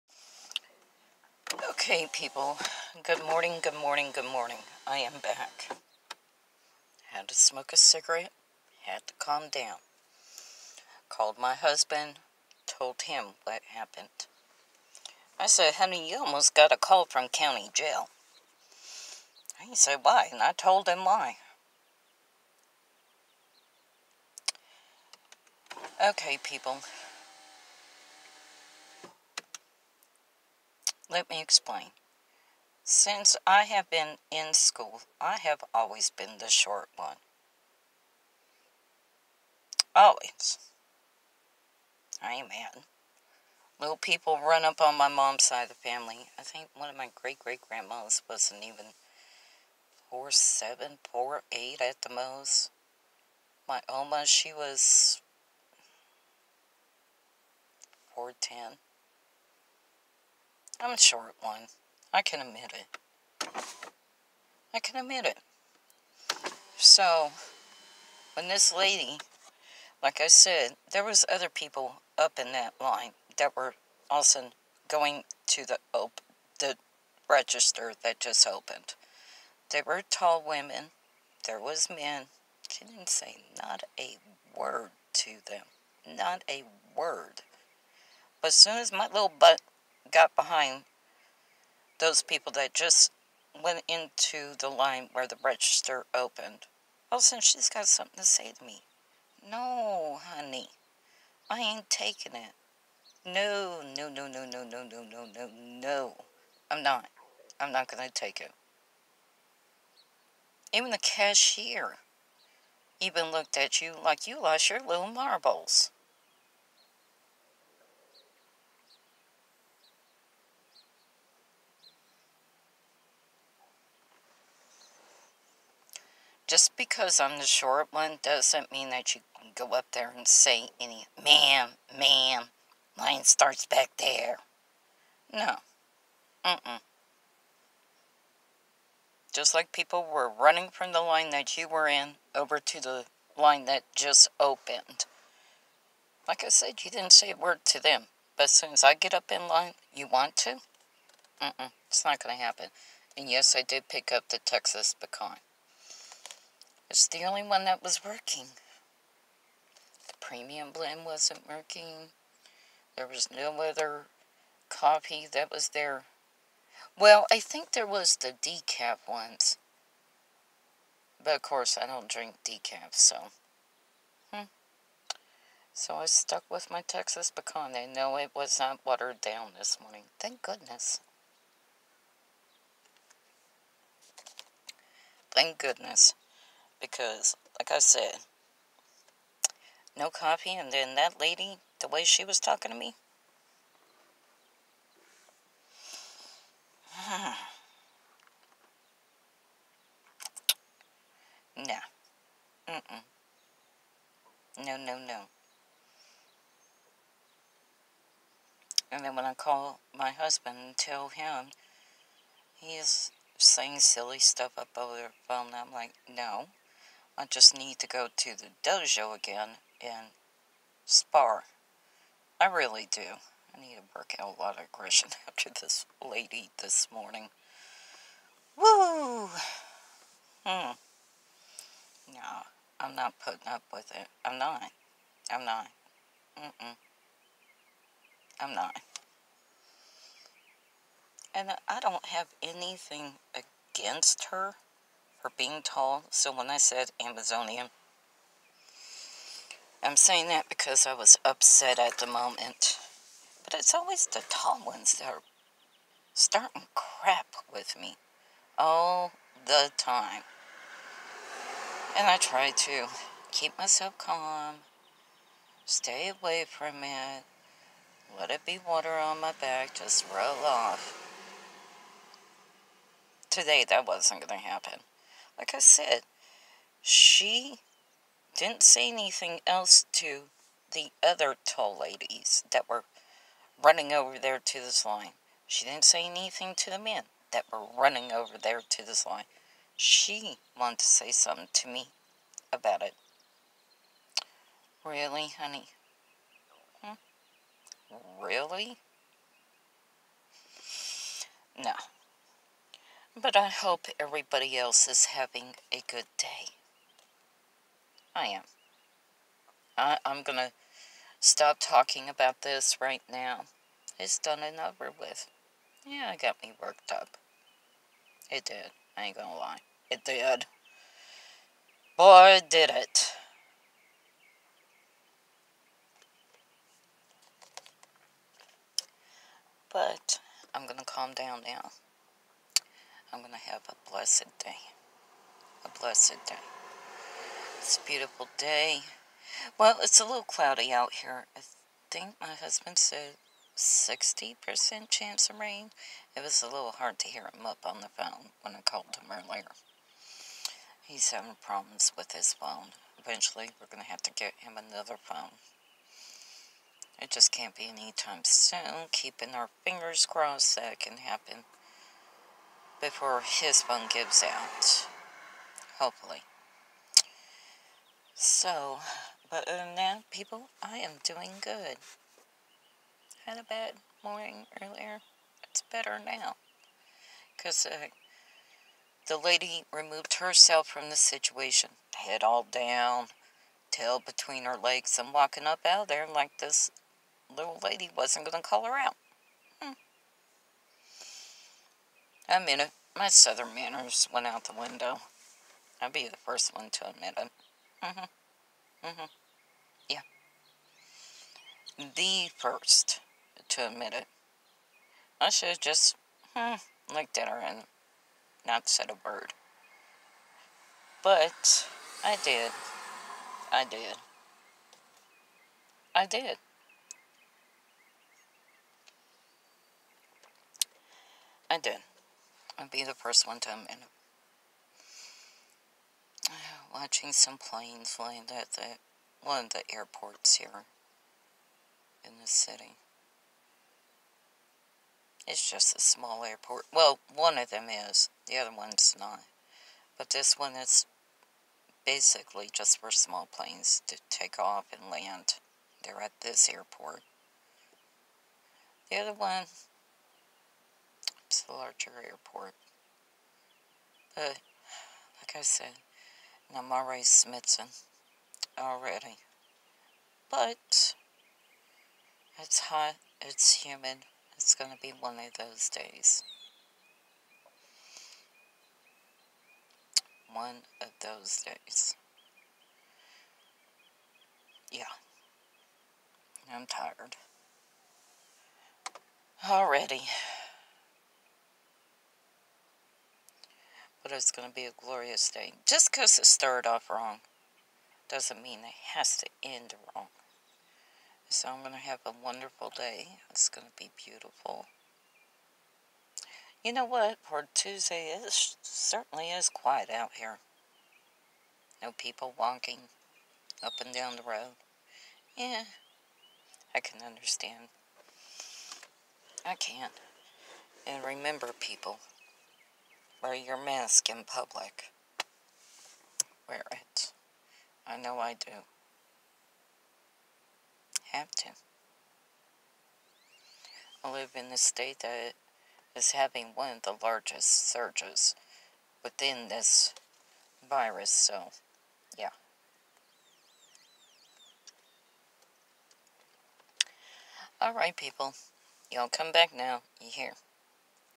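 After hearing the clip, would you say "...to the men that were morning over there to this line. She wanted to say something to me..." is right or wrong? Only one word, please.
wrong.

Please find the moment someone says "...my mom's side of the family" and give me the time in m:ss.
0:44.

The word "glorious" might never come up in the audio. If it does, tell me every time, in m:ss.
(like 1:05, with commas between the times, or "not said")
8:04.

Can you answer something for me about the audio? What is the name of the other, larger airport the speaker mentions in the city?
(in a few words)
Central Archer Airport.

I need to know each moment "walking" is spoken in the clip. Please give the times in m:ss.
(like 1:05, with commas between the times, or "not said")
6:25, 8:22.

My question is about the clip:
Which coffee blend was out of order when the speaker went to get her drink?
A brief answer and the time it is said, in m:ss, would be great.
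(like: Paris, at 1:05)
premium blend, at 2:40.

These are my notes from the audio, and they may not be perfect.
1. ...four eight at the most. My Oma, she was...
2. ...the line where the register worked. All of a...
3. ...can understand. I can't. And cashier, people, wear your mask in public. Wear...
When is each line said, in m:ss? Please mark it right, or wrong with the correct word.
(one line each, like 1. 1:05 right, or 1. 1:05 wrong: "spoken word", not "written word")
1. 0:51 right
2. 1:34 wrong: "opened", not "worked"
3. 8:26 wrong: "remember", not "cashier".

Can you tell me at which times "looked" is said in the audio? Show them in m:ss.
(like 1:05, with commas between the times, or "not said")
1:53, 6:46.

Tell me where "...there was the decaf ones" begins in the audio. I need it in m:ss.
2:47.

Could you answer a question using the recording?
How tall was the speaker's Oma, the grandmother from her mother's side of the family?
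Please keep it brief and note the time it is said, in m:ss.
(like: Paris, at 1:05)
4'10", at 0:58.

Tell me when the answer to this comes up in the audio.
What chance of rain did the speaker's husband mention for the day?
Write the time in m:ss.
5:43.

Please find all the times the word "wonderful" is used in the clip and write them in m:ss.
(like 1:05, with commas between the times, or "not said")
8:12.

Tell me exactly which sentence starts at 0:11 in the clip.
Called my husband, told him what happened.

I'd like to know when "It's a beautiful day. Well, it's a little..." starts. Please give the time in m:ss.
5:37.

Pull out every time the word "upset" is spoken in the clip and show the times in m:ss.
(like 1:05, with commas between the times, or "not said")
4:11.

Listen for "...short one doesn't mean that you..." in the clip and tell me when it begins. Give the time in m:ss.
2:07.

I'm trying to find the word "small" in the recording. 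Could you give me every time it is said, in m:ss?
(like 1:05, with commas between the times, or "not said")
7:15, 7:22.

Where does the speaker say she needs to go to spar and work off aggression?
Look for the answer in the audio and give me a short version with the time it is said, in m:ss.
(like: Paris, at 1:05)
the dojo, at 3:38.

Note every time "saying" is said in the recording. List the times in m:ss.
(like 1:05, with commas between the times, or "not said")
3:33, 4:09.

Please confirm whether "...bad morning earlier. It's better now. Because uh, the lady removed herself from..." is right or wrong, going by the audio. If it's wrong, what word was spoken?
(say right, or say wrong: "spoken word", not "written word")
right.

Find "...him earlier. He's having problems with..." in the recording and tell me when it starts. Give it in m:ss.
5:48.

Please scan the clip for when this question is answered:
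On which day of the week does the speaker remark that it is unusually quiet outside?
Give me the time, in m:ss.
8:17.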